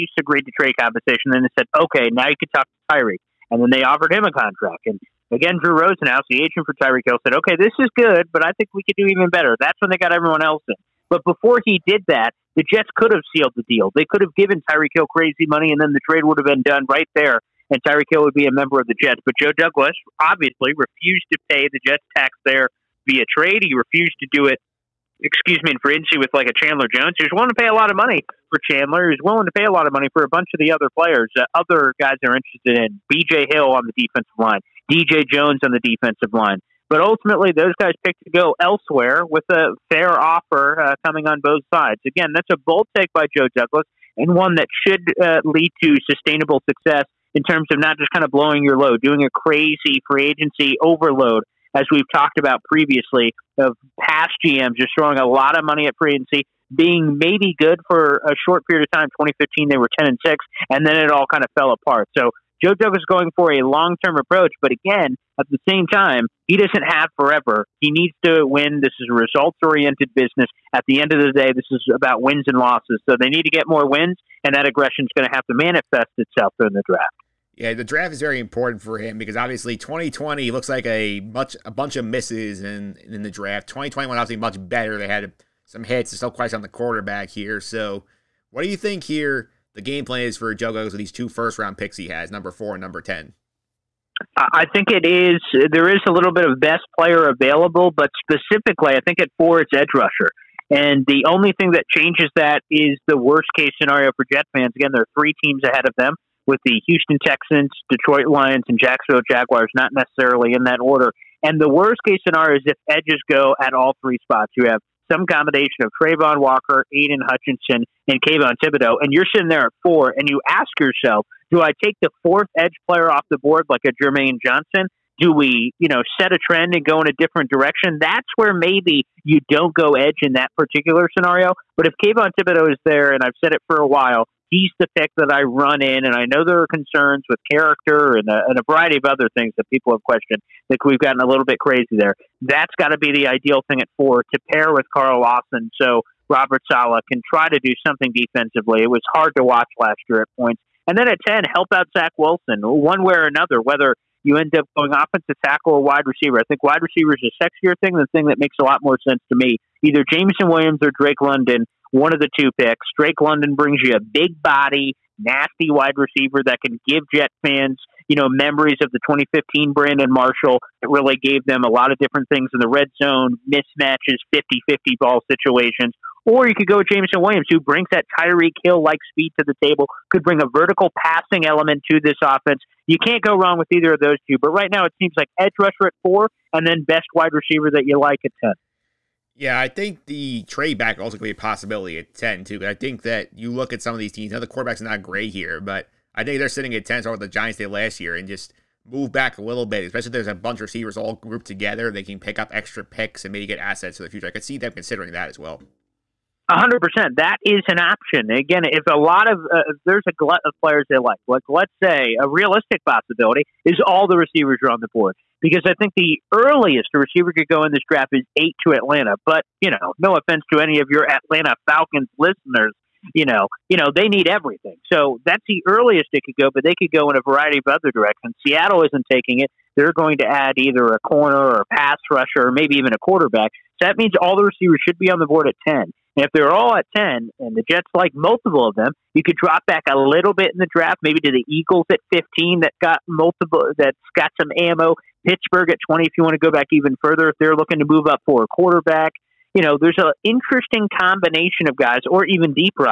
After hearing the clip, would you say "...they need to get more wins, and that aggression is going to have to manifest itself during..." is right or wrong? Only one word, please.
right.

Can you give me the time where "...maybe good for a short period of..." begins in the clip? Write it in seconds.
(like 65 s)
57 s.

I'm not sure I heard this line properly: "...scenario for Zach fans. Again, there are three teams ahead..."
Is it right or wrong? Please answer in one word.
wrong.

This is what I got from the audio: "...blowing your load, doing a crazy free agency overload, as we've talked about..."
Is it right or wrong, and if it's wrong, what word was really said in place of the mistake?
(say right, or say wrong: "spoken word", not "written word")
right.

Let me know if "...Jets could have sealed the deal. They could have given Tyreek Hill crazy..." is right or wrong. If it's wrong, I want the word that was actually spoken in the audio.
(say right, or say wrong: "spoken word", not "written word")
right.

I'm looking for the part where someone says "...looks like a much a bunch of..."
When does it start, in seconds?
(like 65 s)
80 s.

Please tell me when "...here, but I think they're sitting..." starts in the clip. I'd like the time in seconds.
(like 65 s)
195 s.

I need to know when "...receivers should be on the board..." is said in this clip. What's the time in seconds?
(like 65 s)
234 s.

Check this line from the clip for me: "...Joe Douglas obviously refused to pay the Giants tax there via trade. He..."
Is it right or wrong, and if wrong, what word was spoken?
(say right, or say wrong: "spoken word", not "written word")
wrong: "Jets", not "Giants".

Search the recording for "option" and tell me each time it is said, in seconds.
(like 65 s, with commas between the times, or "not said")
207 s.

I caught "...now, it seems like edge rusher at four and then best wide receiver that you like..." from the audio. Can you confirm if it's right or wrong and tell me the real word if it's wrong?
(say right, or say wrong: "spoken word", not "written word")
right.